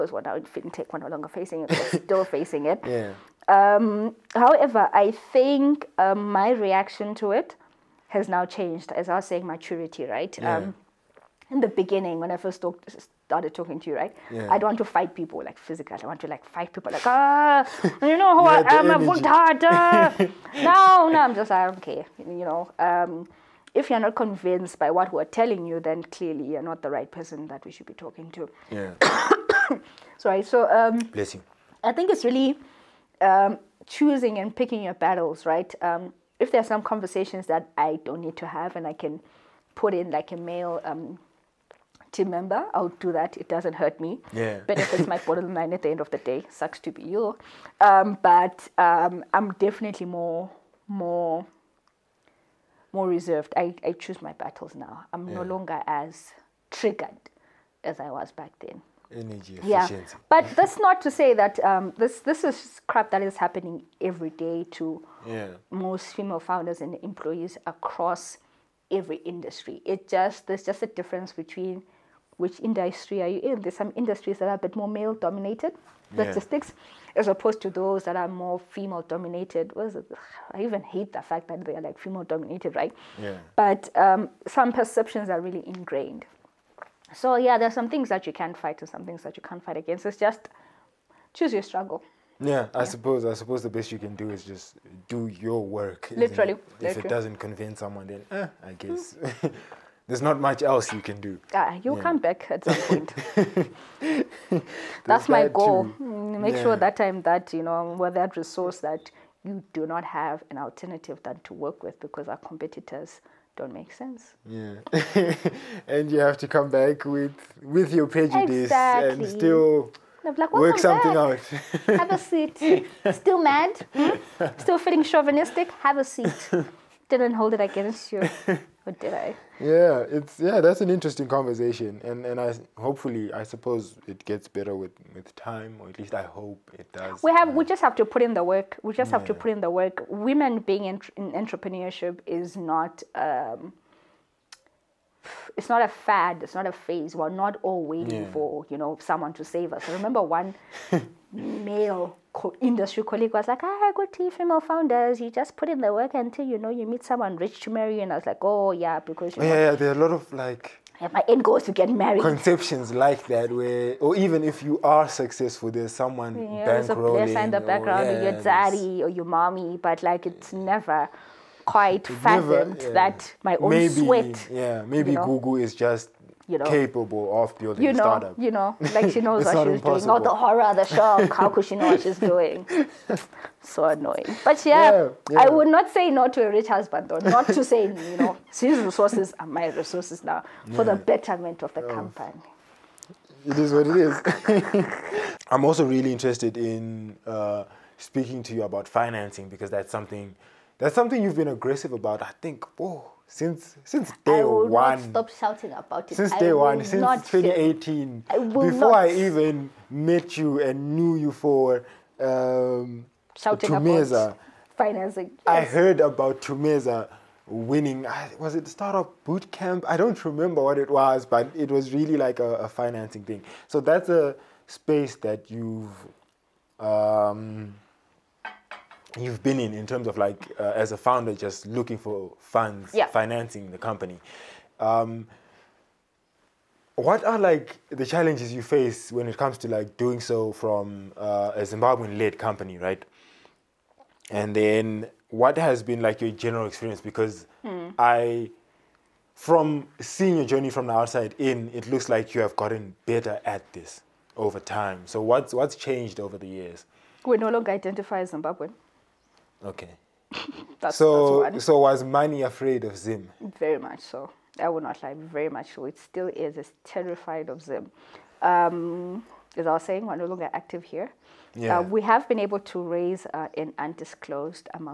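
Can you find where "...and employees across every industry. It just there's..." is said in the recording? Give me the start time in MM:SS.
01:06.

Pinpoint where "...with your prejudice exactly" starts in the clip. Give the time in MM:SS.
01:57.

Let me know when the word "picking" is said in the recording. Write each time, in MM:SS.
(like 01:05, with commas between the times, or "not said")
00:34.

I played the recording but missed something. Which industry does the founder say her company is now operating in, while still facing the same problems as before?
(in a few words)
Fintech.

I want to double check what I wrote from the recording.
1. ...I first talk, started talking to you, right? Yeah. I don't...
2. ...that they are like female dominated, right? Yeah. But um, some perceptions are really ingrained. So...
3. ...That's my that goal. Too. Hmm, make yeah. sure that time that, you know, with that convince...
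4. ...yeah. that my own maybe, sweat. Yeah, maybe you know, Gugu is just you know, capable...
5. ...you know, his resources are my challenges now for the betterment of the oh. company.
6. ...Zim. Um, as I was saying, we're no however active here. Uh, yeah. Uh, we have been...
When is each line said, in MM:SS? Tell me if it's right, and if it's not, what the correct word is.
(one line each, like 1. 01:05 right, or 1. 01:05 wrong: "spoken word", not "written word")
1. 00:12 right
2. 01:21 right
3. 01:45 wrong: "resource", not "convince"
4. 02:52 right
5. 03:07 wrong: "resources", not "challenges"
6. 04:27 wrong: "longer", not "however".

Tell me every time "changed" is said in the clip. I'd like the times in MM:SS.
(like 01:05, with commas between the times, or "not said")
00:08, 04:15.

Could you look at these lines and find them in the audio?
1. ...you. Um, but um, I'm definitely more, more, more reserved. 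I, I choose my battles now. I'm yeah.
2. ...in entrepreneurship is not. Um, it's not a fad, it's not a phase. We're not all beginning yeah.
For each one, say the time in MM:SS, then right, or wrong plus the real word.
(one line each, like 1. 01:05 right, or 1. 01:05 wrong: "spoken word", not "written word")
1. 00:47 right
2. 02:21 wrong: "waiting", not "beginning".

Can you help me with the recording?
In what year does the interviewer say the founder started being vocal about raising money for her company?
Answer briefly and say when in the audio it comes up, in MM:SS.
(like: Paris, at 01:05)
2018, at 03:27.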